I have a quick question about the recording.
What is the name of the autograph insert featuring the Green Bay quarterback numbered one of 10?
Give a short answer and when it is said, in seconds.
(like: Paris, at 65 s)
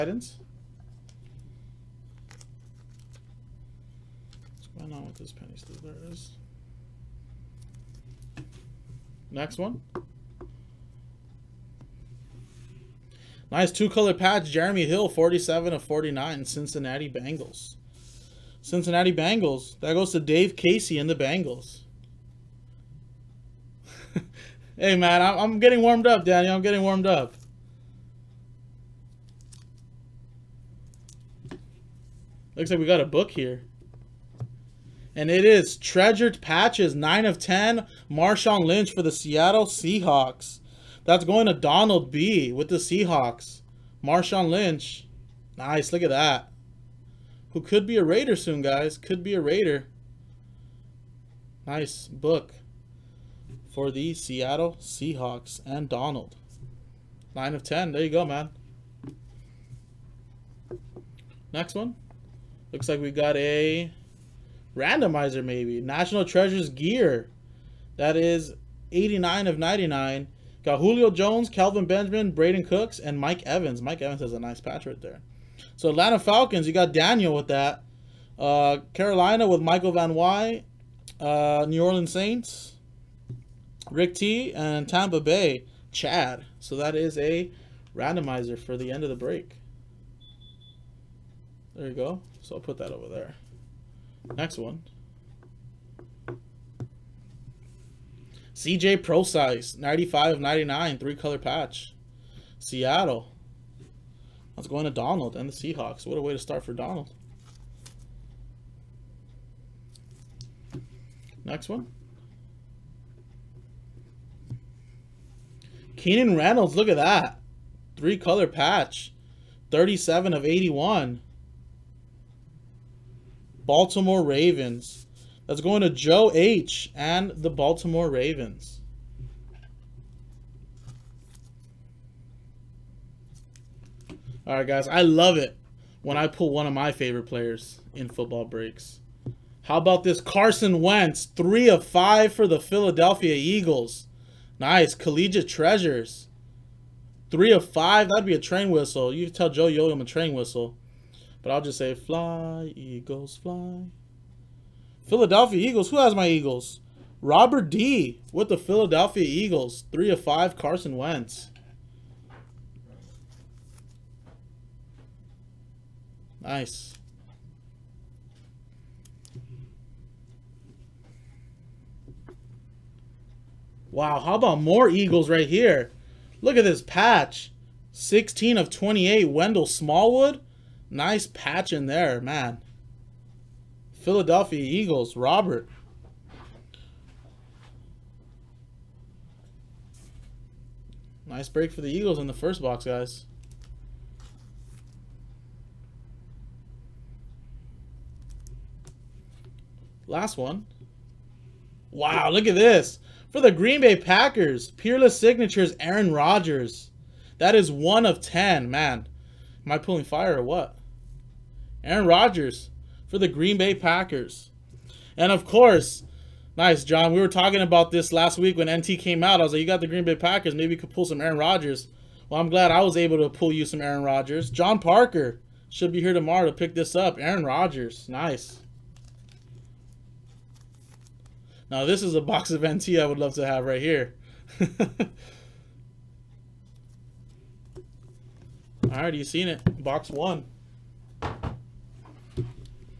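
Peerless Signatures, at 204 s.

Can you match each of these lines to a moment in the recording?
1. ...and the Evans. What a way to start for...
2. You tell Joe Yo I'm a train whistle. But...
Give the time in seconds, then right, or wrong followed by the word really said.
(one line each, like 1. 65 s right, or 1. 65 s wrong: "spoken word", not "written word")
1. 105 s wrong: "Seahawks", not "Evans"
2. 149 s right.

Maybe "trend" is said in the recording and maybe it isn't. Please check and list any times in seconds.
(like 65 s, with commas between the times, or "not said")
not said.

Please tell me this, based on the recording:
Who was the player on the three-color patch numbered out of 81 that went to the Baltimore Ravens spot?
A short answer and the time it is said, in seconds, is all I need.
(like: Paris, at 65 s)
Keenan Reynolds, at 115 s.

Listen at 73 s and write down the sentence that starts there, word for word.
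Mike Evans has a nice patch right there.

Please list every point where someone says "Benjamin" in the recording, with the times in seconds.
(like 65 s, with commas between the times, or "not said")
71 s.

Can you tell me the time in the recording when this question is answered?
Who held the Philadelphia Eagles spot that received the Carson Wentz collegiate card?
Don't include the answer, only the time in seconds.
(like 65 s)
157 s.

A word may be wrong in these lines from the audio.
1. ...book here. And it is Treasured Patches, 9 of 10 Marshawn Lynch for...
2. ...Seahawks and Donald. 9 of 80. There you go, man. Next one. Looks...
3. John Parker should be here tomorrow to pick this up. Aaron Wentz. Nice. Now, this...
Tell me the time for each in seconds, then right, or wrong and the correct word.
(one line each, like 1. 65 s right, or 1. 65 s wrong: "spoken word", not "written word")
1. 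33 s right
2. 54 s wrong: "10", not "80"
3. 224 s wrong: "Rodgers", not "Wentz".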